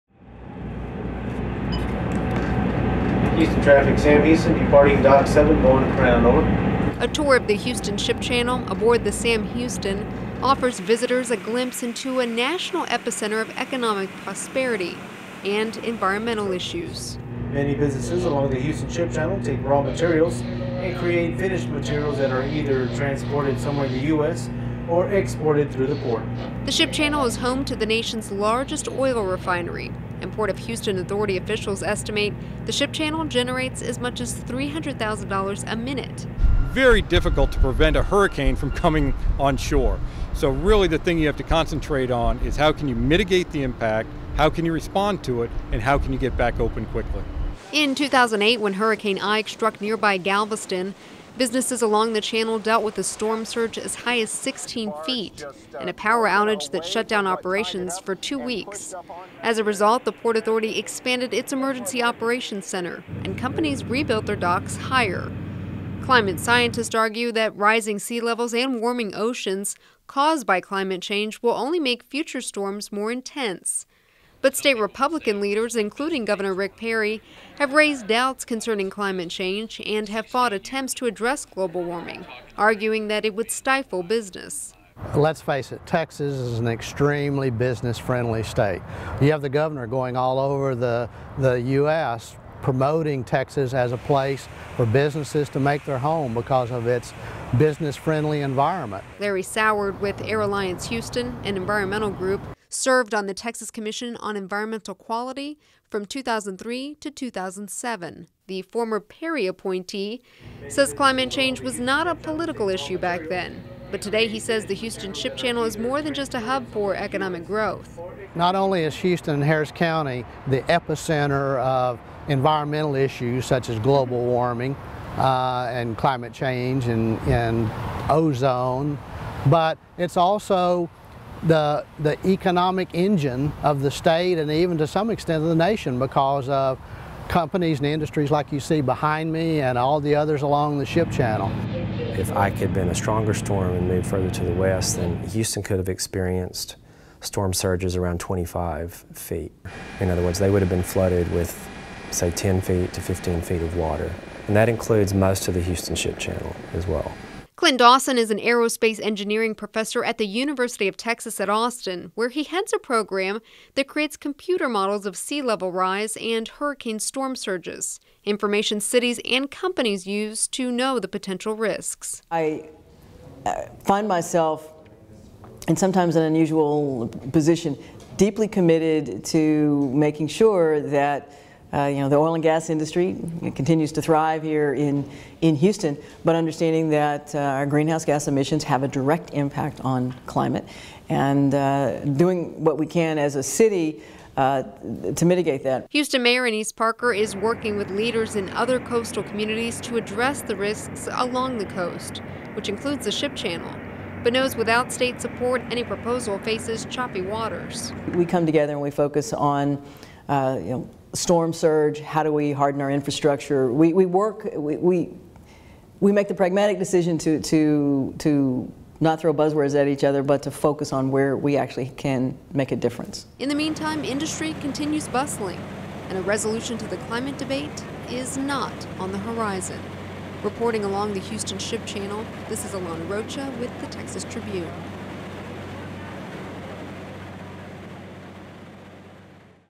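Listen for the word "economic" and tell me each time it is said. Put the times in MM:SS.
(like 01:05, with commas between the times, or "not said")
00:13, 01:56, 02:12.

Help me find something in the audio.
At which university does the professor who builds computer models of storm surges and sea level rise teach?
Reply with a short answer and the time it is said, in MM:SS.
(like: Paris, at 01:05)
University of Texas at Austin, at 02:40.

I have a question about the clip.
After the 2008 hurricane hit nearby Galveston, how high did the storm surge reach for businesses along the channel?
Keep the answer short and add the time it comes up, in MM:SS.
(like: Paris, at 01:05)
16 feet, at 00:54.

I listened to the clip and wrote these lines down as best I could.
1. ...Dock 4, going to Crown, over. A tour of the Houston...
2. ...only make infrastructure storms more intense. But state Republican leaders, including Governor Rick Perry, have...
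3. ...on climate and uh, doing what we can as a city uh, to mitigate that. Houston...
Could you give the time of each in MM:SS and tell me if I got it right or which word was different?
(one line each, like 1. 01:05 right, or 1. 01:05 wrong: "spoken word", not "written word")
1. 00:05 wrong: "7", not "4"
2. 01:11 wrong: "future", not "infrastructure"
3. 03:09 right.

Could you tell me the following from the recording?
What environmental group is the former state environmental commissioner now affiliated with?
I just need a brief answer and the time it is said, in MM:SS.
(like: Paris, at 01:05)
Air Alliance Houston, at 01:40.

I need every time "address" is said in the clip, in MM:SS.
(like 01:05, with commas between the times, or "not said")
01:21, 03:19.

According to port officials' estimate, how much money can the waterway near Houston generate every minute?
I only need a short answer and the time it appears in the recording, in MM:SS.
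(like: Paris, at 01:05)
$300,000, at 00:34.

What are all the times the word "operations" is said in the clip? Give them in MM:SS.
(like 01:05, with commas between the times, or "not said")
00:57, 01:02.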